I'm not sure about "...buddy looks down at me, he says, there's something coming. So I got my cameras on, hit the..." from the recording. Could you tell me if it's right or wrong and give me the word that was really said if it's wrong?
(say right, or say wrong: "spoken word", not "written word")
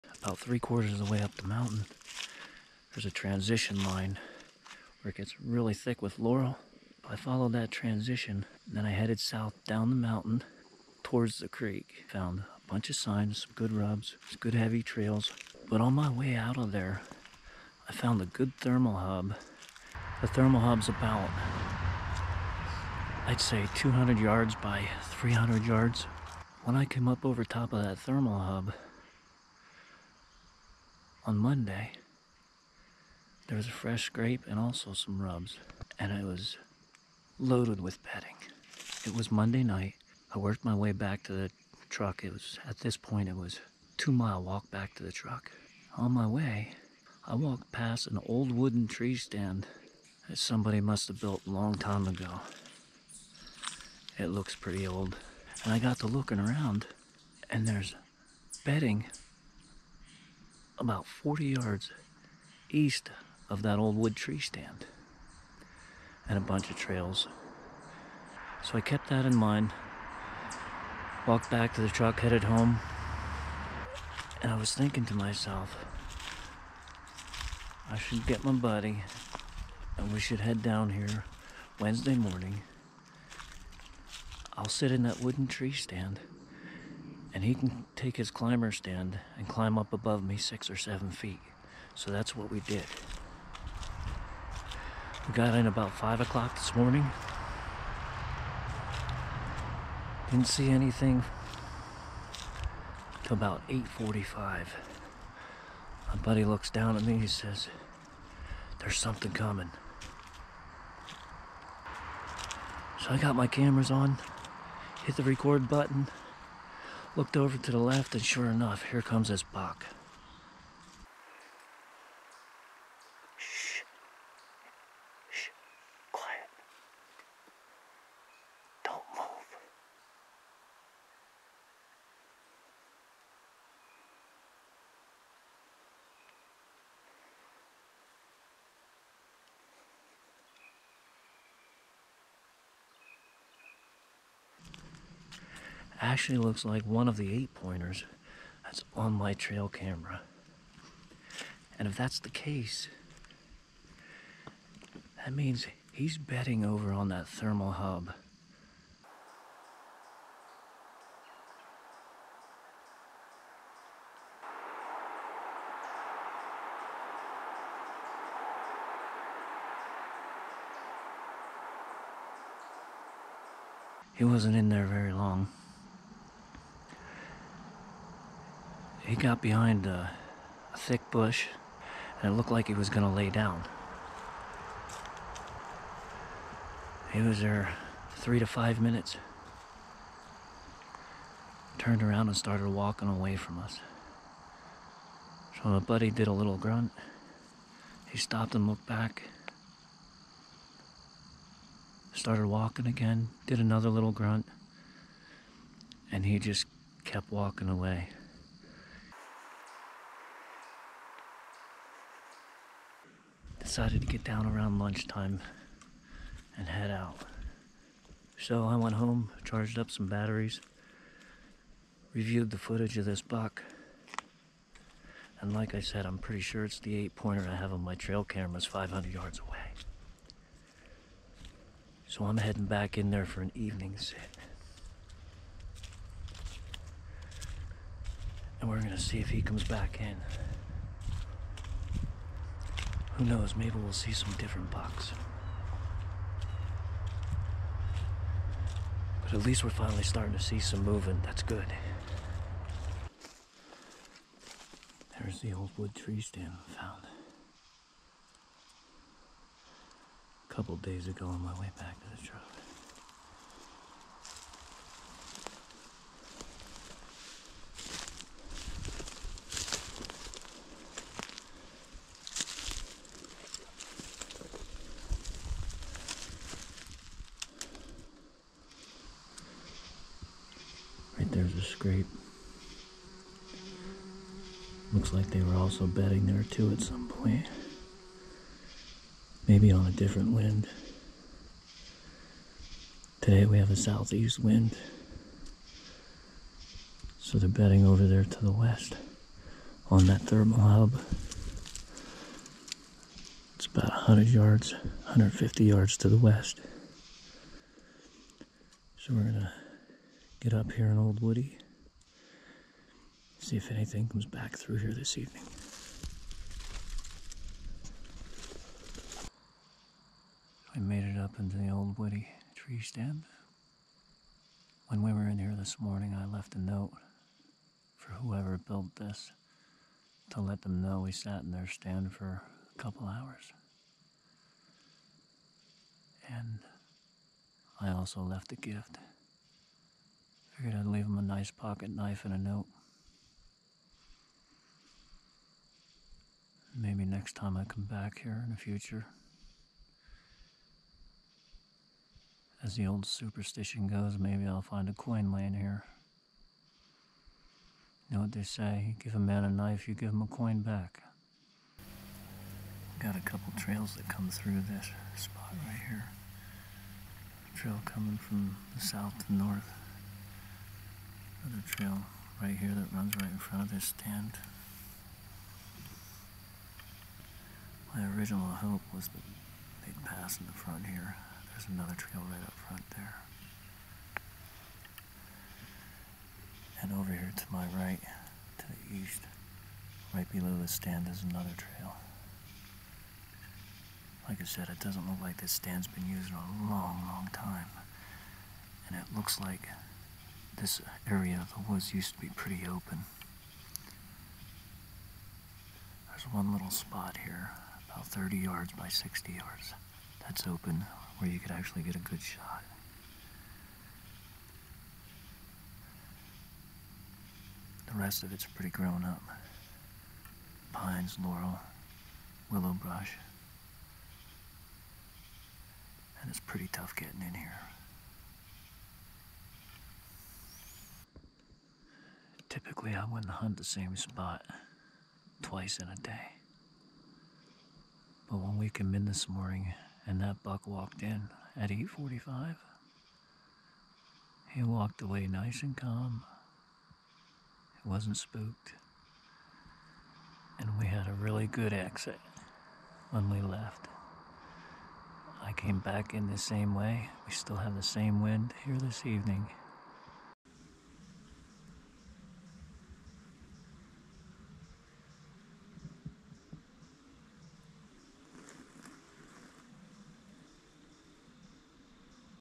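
right.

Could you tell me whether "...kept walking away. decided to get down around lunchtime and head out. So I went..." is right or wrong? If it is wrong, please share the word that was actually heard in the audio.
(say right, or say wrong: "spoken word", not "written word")
right.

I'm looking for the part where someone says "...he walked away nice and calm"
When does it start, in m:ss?
7:24.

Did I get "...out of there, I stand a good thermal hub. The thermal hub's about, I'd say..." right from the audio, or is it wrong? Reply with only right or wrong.
wrong.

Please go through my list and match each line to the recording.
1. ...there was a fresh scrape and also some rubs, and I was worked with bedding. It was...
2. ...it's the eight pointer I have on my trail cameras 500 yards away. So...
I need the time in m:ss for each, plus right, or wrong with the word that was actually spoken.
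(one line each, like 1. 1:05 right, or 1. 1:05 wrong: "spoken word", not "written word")
1. 0:33 wrong: "loaded", not "worked"
2. 3:46 right.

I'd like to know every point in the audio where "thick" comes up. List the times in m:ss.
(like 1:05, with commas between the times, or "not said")
0:05, 3:00.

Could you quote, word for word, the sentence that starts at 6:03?
Got a couple trails that come through this spot right here.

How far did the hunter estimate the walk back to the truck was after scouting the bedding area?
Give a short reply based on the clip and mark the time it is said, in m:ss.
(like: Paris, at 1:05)
2 miles, at 0:43.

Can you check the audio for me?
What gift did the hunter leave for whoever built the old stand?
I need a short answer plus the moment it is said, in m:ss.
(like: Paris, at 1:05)
pocket knife, at 5:41.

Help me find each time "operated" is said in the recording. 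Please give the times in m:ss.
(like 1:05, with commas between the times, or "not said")
not said.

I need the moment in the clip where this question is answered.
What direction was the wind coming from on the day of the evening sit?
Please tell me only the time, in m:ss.
4:53.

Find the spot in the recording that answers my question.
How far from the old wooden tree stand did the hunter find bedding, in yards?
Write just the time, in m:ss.
1:01.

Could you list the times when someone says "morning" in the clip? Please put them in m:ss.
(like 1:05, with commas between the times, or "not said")
1:22, 1:36, 5:25, 7:19.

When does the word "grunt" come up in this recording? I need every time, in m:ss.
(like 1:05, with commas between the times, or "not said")
3:16, 3:24.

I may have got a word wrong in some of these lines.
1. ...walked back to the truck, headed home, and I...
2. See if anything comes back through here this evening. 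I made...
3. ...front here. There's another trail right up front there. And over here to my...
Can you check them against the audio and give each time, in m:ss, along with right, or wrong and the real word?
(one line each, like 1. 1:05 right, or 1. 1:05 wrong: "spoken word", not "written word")
1. 1:11 right
2. 5:13 right
3. 6:20 right.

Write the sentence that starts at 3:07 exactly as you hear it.
He was there three to five minutes.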